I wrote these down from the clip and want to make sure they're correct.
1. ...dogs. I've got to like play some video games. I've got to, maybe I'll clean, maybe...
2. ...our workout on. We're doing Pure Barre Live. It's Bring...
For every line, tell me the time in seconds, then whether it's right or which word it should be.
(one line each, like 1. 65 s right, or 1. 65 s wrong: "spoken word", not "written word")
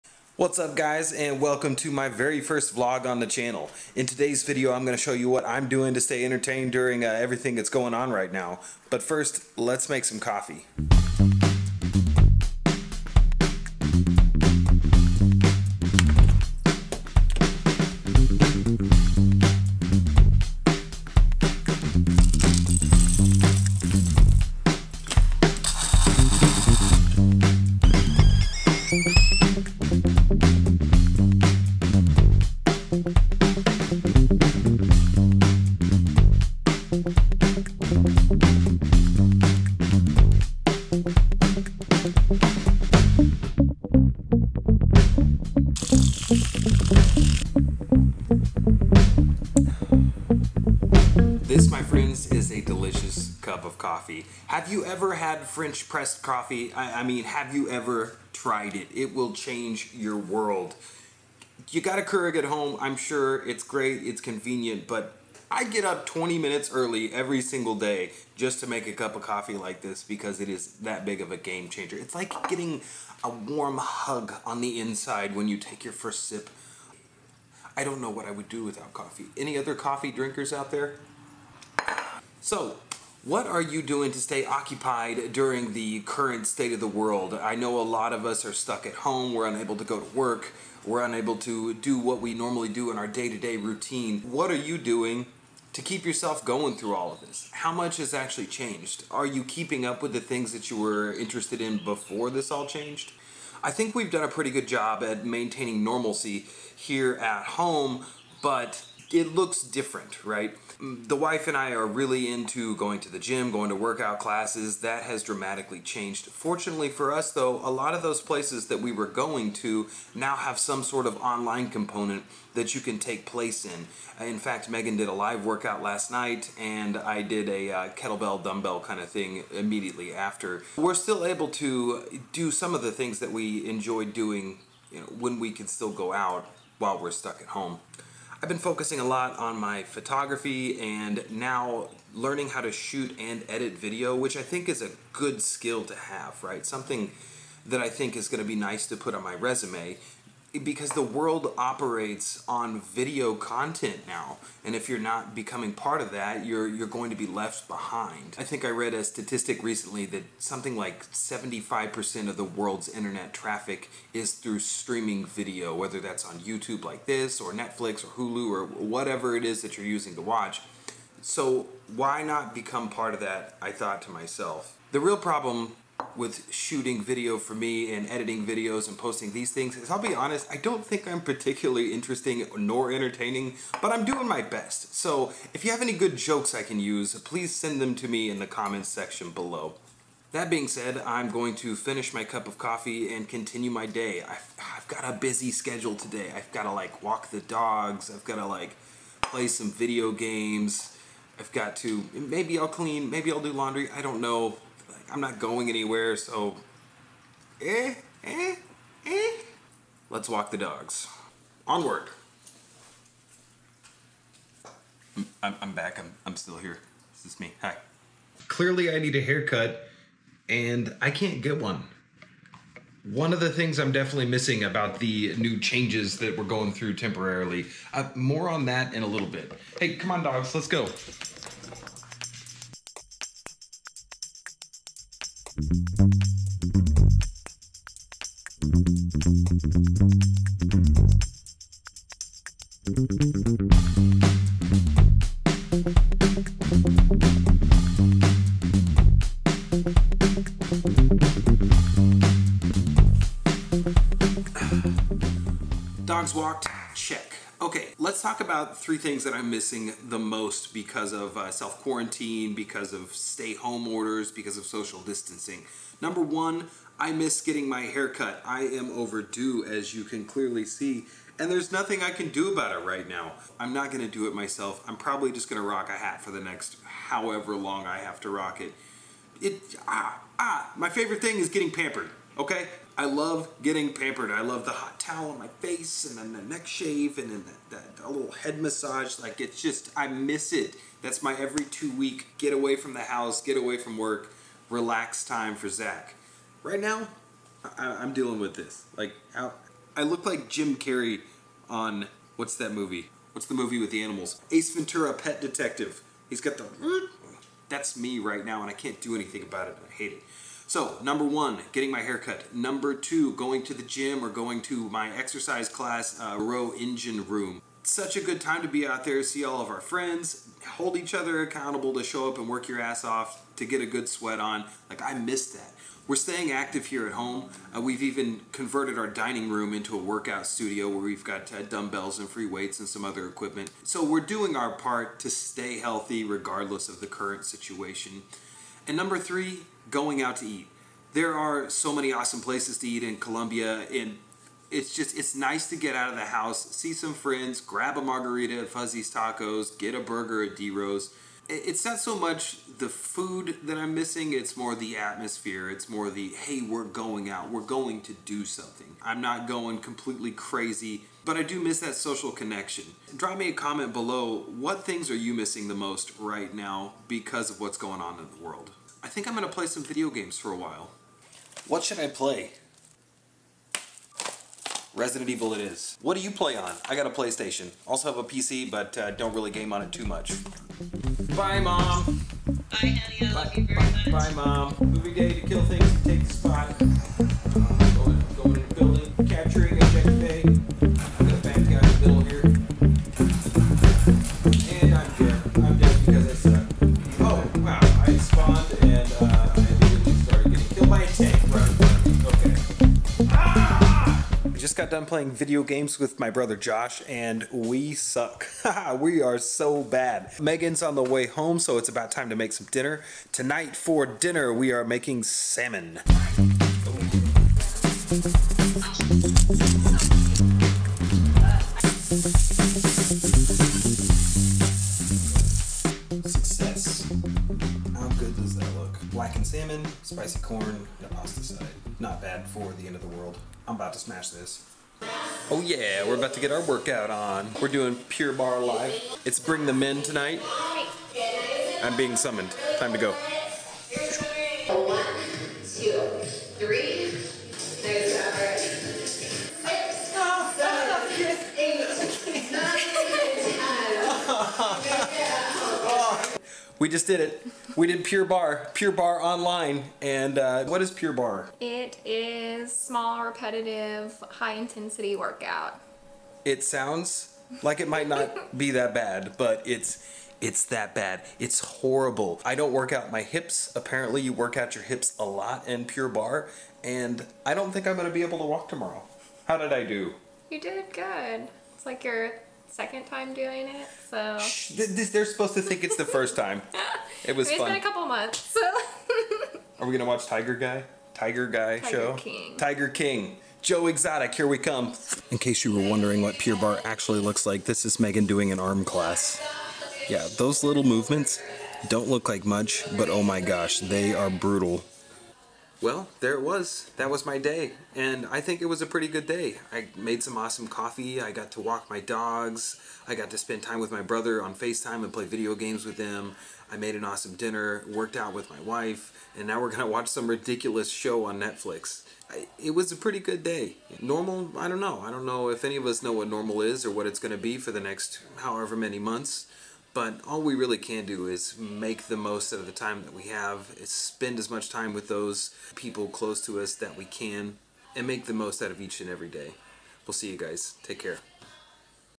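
1. 197 s right
2. 436 s right.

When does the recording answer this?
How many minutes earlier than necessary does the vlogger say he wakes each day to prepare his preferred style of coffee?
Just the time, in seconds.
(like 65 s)
66 s.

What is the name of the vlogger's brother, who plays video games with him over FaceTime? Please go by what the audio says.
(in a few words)
Josh.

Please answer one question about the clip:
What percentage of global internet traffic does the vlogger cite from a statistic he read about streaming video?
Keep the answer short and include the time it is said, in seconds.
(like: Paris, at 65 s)
75%, at 161 s.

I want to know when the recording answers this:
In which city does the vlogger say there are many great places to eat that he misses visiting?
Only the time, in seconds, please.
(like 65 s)
343 s.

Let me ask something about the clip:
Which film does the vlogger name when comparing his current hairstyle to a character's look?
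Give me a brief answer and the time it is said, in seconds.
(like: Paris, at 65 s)
Ace Ventura Pet Detective, at 304 s.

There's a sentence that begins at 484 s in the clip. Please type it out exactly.
Shh, they're supposed to think it's the first time.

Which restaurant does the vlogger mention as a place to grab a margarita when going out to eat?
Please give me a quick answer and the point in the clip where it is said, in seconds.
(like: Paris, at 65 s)
Fuzzy's Tacos, at 348 s.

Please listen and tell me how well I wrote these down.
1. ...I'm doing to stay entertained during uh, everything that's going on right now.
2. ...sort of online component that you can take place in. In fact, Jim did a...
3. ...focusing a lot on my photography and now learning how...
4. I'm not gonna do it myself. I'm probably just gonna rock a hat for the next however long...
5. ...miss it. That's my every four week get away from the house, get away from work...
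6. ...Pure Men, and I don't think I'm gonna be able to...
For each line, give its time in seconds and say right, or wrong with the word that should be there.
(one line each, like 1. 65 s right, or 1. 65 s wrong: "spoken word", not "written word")
1. 5 s right
2. 120 s wrong: "Megan", not "Jim"
3. 138 s right
4. 273 s right
5. 290 s wrong: "two", not "four"
6. 475 s wrong: "Barre", not "Men".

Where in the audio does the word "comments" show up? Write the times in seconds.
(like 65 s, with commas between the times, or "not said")
188 s, 363 s.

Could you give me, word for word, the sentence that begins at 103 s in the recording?
I think we've done a pretty good job at maintaining normalcy here at home, but it looks different, right?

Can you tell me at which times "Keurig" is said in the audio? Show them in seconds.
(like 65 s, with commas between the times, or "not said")
62 s.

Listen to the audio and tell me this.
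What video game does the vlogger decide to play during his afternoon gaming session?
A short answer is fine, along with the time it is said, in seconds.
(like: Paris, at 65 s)
Resident Evil, at 374 s.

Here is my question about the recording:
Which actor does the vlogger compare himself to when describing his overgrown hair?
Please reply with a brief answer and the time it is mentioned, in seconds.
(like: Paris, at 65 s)
Jim Carrey, at 300 s.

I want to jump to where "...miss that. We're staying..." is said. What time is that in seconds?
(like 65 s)
325 s.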